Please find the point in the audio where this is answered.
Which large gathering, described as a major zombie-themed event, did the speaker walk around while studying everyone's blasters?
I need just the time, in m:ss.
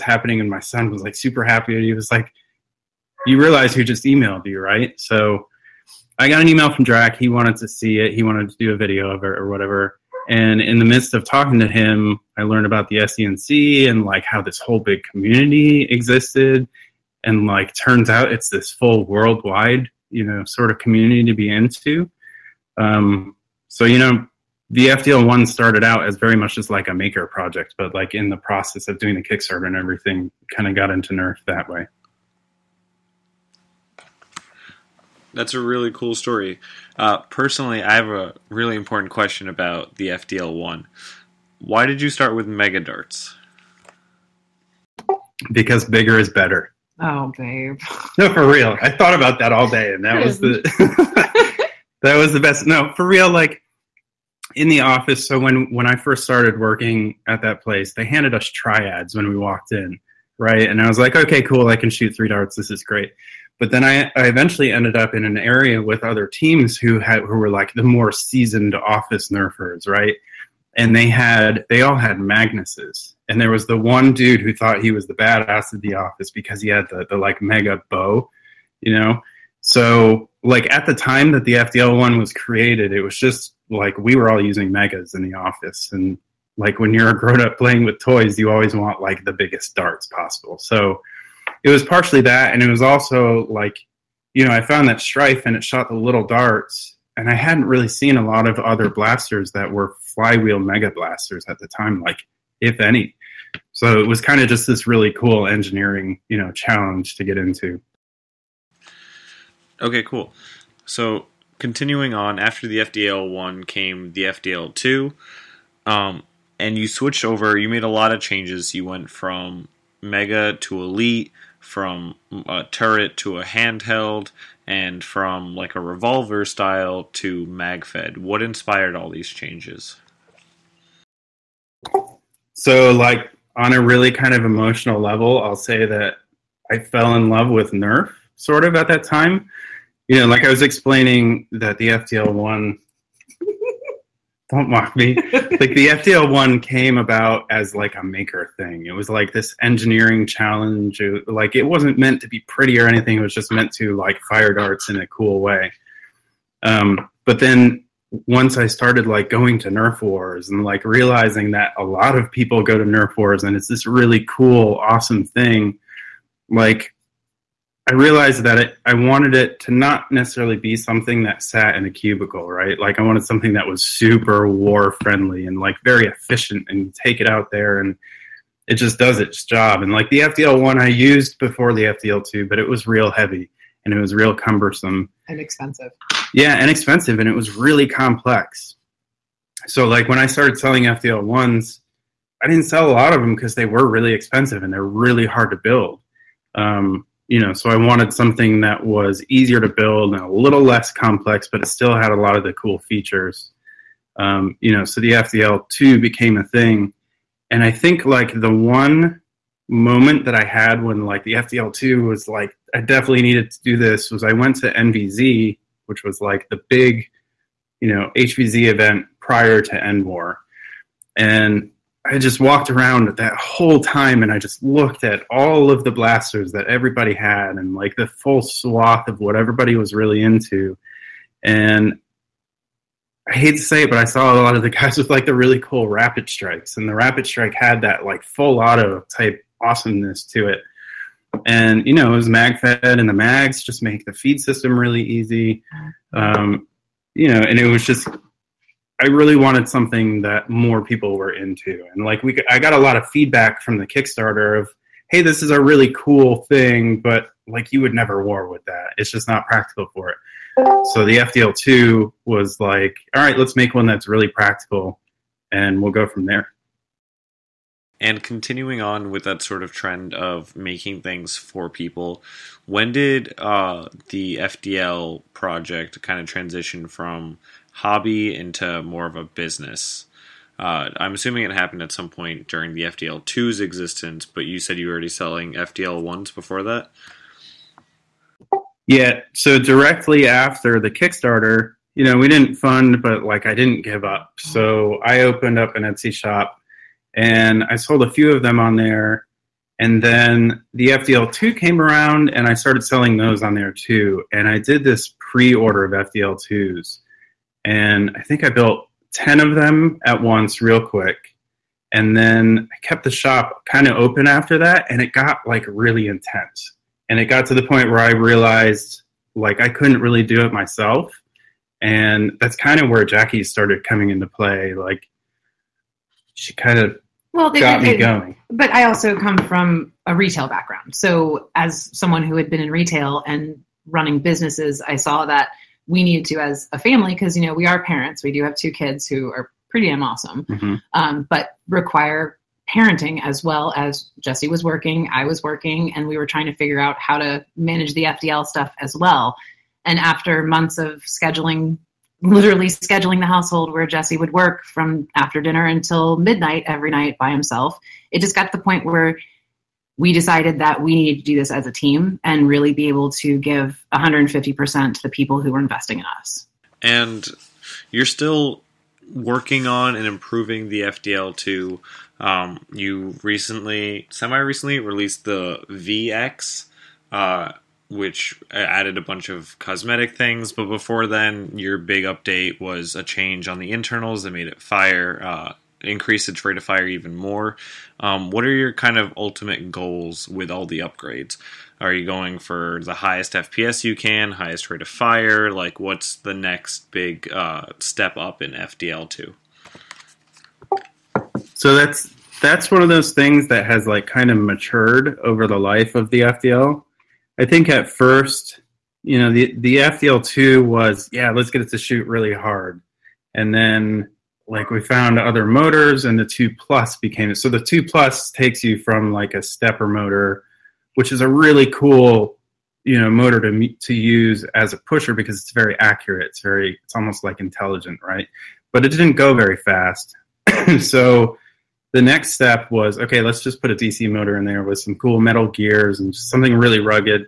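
3:34.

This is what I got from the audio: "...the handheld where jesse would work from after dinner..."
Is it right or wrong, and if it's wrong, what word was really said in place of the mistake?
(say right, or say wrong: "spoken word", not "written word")
wrong: "household", not "handheld".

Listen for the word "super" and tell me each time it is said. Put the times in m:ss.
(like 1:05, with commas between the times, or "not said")
0:01, 2:53.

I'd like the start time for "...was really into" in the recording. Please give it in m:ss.
3:49.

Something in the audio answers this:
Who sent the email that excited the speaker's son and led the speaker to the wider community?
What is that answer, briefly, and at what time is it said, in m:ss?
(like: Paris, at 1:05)
Drac, at 0:06.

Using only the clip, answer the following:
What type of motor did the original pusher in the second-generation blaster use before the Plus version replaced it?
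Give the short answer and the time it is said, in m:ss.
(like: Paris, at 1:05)
Stepper motor, at 6:59.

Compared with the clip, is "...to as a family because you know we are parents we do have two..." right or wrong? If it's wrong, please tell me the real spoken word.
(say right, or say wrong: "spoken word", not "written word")
right.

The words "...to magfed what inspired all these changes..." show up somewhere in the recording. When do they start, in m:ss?
2:07.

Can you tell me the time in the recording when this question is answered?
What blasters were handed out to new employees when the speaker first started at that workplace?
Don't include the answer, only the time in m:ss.
0:58.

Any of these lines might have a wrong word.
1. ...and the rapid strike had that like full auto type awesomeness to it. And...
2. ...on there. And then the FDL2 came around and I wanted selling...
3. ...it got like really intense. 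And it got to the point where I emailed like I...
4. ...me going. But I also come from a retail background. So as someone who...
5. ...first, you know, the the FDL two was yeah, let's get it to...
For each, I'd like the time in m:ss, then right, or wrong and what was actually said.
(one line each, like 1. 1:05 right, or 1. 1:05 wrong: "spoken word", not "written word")
1. 3:56 right
2. 4:58 wrong: "started", not "wanted"
3. 5:15 wrong: "realized", not "emailed"
4. 5:27 right
5. 6:47 right.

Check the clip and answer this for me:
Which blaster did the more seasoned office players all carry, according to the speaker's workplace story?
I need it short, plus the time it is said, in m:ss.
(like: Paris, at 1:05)
Magnuses, at 1:12.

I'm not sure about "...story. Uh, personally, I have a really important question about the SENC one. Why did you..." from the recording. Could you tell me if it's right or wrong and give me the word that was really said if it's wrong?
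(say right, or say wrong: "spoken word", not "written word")
wrong: "FDL", not "SENC".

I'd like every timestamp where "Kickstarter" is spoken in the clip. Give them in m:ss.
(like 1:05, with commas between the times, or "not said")
0:29, 4:13, 4:50.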